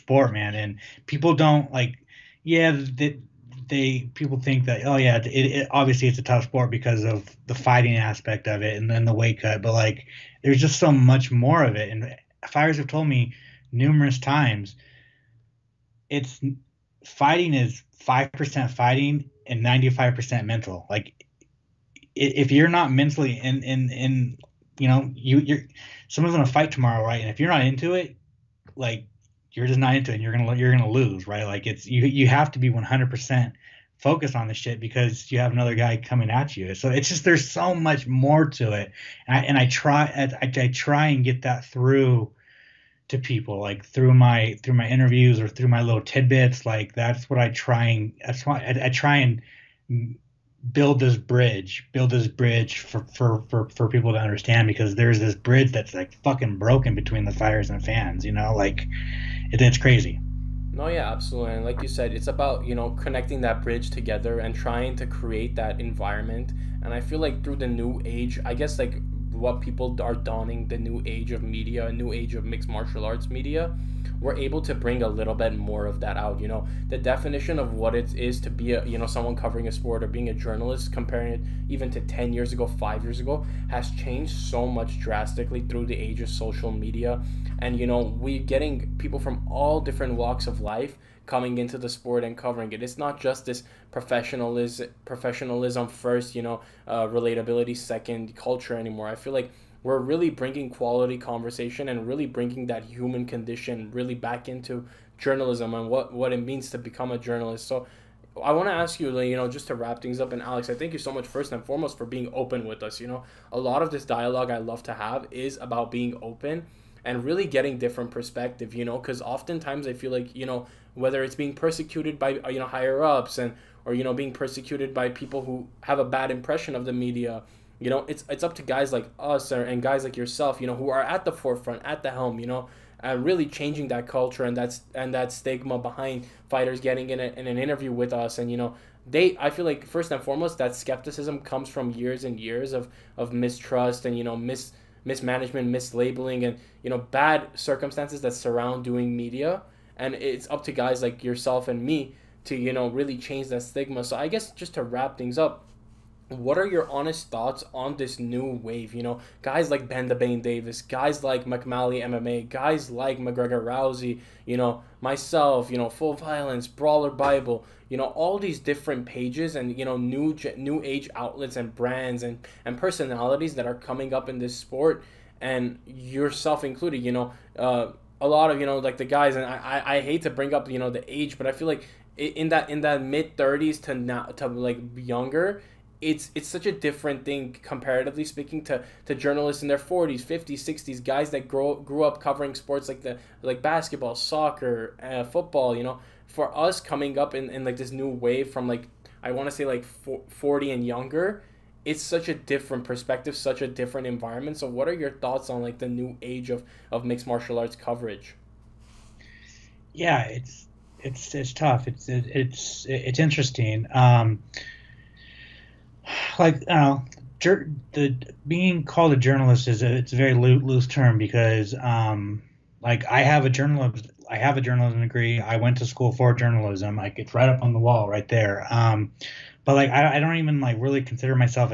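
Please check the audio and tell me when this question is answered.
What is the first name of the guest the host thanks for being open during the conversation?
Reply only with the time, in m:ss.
1:50.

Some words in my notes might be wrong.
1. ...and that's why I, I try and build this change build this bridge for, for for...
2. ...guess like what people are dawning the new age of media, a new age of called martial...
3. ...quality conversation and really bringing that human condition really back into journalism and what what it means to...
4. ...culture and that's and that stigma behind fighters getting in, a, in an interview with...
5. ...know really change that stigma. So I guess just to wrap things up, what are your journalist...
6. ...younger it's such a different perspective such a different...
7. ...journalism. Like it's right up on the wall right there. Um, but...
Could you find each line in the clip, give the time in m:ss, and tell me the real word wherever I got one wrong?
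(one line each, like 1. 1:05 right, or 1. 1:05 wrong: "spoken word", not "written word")
1. 0:47 wrong: "bridge", not "change"
2. 1:08 wrong: "mixed", not "called"
3. 1:40 right
4. 2:14 right
5. 2:32 wrong: "honest", not "journalist"
6. 3:20 right
7. 3:46 right.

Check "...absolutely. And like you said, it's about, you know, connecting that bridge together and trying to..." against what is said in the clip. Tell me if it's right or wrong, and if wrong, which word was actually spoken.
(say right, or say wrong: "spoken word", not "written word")
right.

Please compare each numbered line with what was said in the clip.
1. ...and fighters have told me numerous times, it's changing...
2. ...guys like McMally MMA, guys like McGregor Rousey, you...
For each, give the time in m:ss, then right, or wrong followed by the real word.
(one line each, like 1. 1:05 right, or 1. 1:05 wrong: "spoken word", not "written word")
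1. 0:11 wrong: "fighting", not "changing"
2. 2:40 right.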